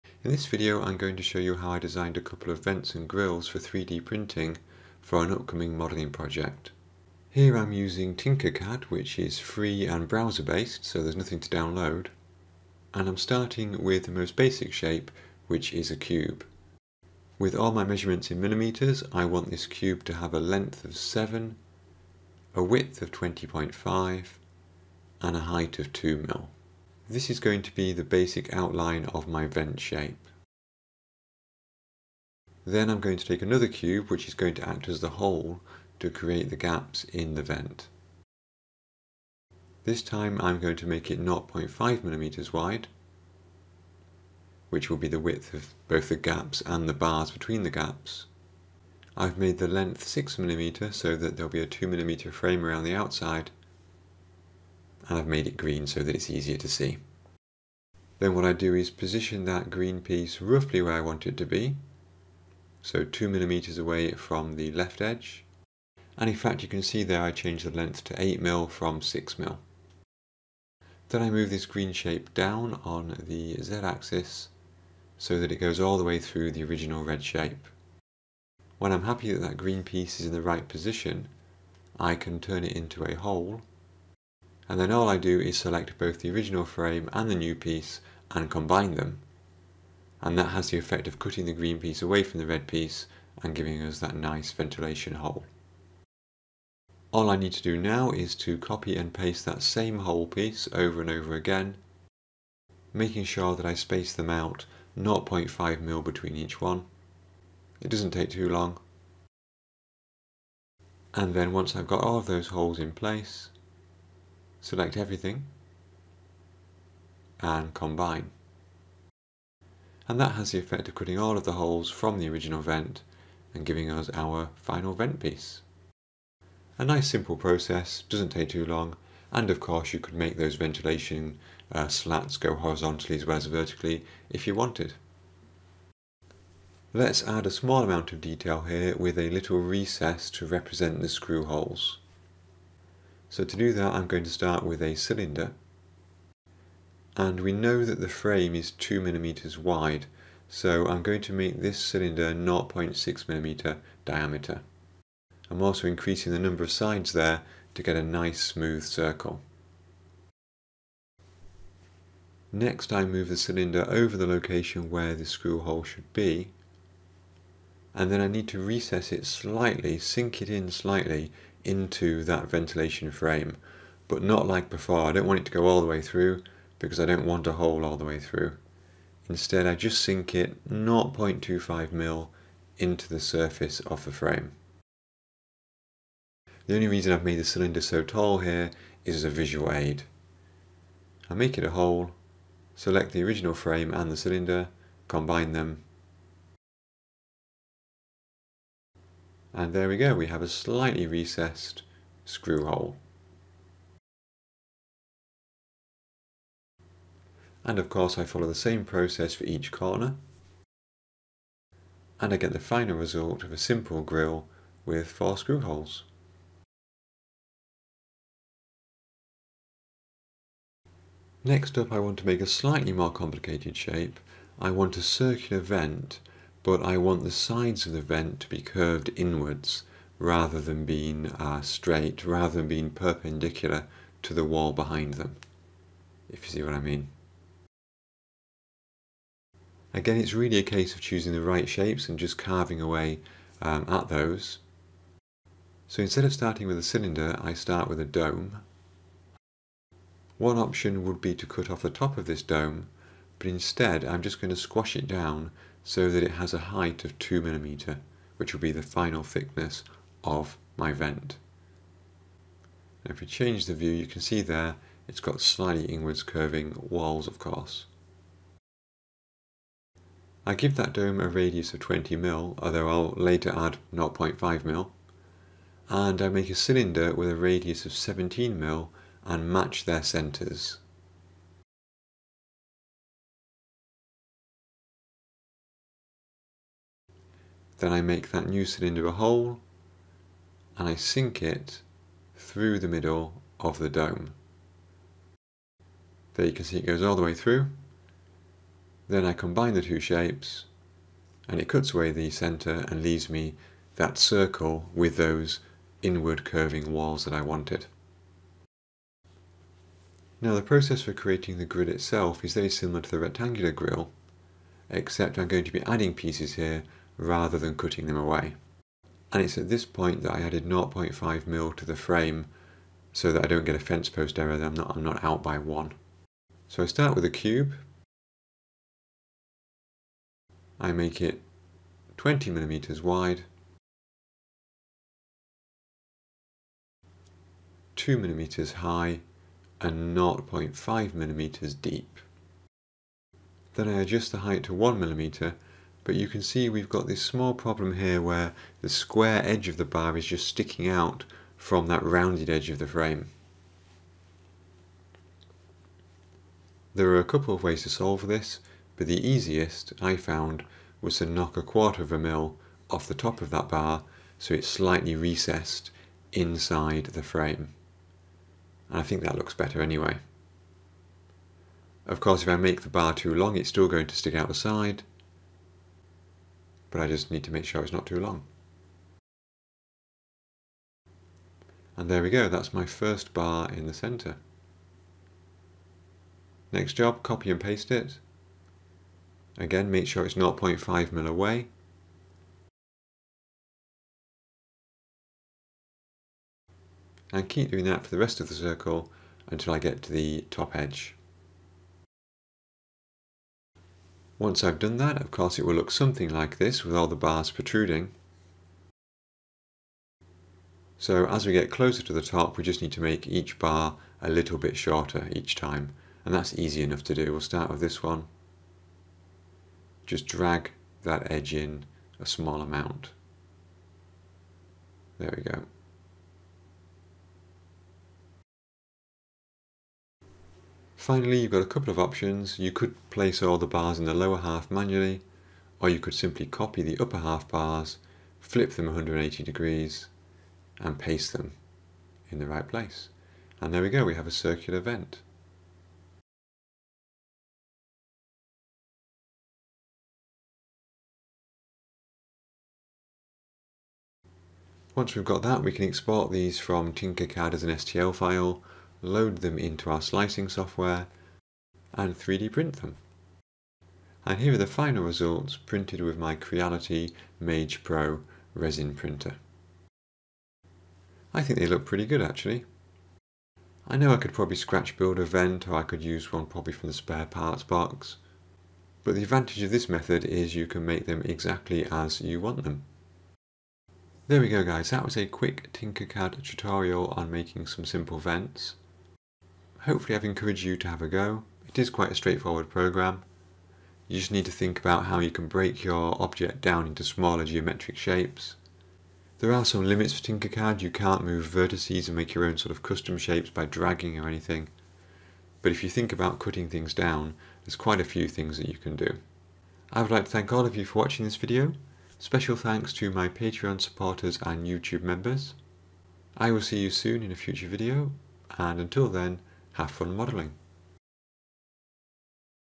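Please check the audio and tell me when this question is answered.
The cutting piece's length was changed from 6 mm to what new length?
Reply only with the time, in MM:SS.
01:08.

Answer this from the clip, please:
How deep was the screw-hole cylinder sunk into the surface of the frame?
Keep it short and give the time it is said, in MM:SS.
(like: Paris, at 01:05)
0.25 mm, at 03:00.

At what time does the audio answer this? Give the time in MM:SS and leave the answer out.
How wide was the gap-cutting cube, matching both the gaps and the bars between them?
00:41.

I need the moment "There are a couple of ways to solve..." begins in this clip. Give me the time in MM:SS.
05:56.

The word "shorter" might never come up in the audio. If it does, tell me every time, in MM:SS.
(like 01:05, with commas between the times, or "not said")
06:54.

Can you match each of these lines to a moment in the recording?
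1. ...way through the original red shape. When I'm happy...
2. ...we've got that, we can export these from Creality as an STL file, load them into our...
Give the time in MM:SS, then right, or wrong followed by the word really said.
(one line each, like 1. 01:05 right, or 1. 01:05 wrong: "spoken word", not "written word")
1. 01:16 right
2. 07:35 wrong: "Tinkercad", not "Creality".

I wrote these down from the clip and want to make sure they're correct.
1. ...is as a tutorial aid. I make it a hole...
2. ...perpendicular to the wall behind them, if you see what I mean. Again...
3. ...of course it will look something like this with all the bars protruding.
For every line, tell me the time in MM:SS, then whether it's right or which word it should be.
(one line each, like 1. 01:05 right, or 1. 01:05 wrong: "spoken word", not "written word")
1. 03:09 wrong: "visual", not "tutorial"
2. 03:52 right
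3. 06:45 right.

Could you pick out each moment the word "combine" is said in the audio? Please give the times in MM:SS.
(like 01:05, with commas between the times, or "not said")
01:28, 01:57, 03:15, 04:59.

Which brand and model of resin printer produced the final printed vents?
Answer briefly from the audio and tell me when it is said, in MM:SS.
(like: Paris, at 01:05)
Creality Mage Pro, at 07:46.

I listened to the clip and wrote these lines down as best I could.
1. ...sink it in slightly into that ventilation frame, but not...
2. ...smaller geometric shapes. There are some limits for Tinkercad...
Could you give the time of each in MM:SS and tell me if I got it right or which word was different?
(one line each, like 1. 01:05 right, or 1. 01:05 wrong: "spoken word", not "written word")
1. 02:49 right
2. 08:17 right.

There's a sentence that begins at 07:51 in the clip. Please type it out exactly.
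I think they look pretty good actually.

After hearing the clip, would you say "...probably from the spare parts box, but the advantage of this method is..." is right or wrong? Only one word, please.
right.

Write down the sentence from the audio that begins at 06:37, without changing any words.
And keep doing that for the rest of the circle until I get to the top edge.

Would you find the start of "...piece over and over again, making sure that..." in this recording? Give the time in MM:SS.
01:40.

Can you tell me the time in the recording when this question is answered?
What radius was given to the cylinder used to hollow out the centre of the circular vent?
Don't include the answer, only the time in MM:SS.
04:37.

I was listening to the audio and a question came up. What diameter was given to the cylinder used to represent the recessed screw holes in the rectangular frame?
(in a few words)
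0.6 millimeter.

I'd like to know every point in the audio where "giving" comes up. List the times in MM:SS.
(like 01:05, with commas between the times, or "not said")
01:33, 02:03.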